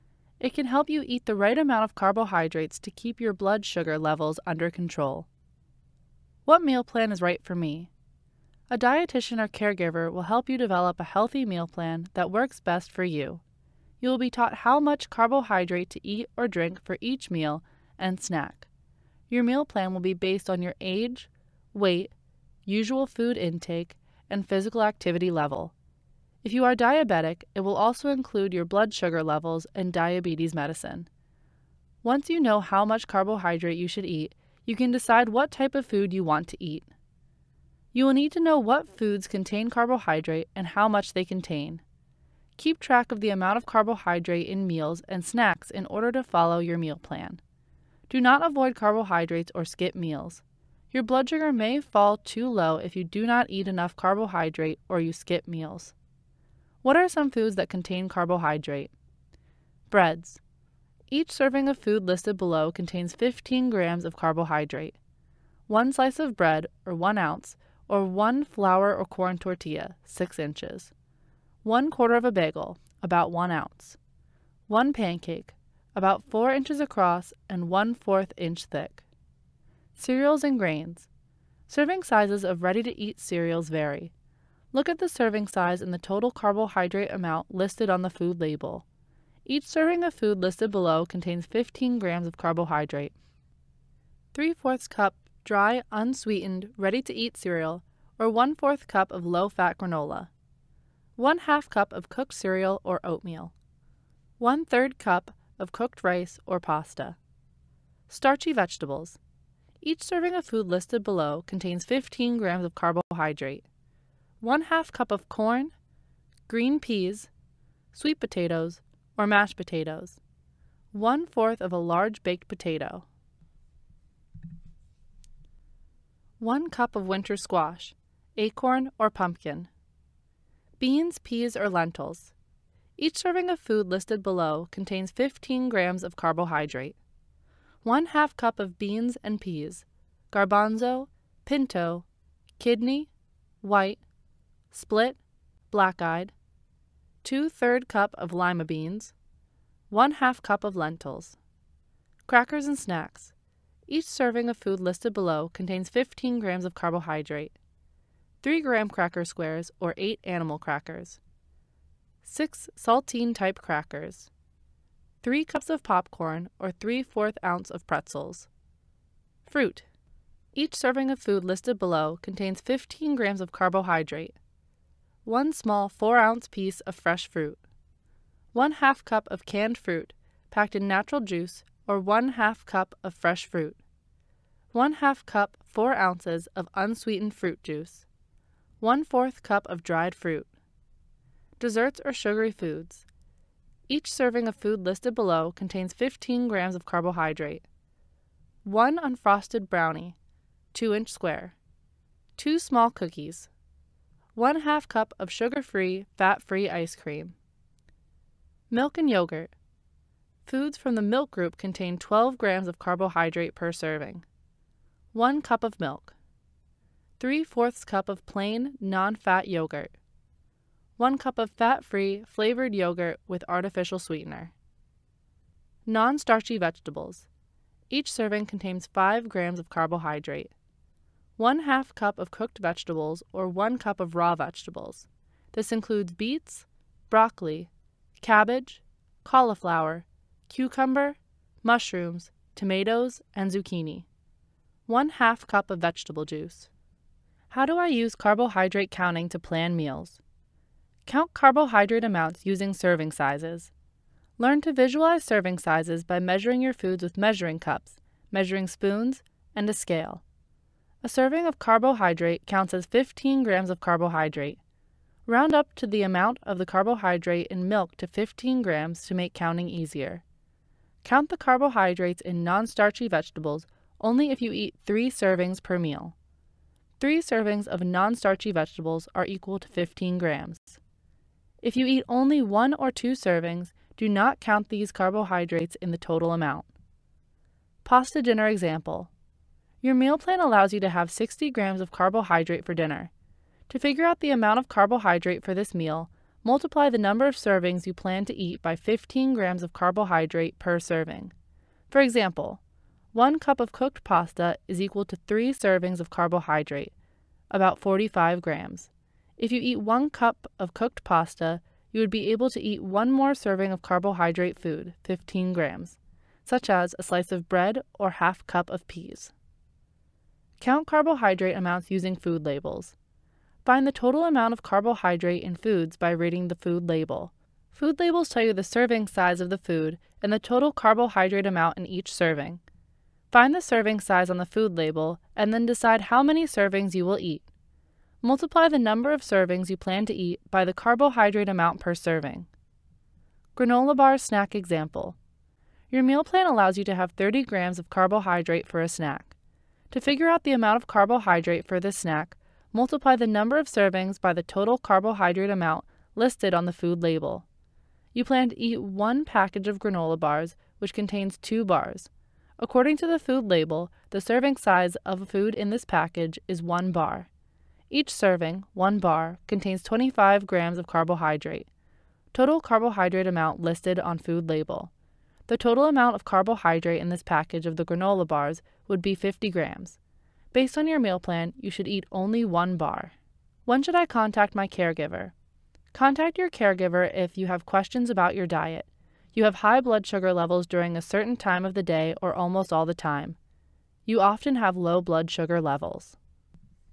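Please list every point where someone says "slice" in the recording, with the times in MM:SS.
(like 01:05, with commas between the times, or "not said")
01:05, 05:17.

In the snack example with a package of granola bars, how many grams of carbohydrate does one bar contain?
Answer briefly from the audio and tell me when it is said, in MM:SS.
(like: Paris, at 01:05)
25 grams, at 06:09.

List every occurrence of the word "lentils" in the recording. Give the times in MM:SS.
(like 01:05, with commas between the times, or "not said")
02:11, 02:30.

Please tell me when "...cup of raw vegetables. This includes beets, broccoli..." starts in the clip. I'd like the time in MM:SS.
03:53.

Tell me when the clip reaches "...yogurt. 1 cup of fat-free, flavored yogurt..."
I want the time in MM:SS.
03:39.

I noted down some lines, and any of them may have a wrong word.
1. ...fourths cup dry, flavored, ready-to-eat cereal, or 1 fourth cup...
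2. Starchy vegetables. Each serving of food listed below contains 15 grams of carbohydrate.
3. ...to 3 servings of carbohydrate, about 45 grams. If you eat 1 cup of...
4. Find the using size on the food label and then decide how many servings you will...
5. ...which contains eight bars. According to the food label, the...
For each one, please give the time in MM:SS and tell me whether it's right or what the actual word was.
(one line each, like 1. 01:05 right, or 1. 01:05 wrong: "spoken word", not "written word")
1. 01:34 wrong: "unsweetened", not "flavored"
2. 01:48 right
3. 05:05 right
4. 05:33 wrong: "serving", not "using"
5. 06:00 wrong: "two", not "eight".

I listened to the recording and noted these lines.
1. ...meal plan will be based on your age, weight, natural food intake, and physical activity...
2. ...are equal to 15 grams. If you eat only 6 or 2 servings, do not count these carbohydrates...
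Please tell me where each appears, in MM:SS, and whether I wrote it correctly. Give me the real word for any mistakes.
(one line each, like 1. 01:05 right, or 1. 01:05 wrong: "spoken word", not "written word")
1. 00:19 wrong: "usual", not "natural"
2. 04:39 wrong: "1", not "6".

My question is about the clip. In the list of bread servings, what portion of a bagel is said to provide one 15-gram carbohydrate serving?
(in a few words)
One quarter.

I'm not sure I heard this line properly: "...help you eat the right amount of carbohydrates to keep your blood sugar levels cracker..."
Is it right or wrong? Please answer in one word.
wrong.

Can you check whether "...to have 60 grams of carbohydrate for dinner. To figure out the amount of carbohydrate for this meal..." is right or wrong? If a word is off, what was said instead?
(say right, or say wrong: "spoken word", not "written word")
right.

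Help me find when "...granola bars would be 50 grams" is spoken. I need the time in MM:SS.
06:17.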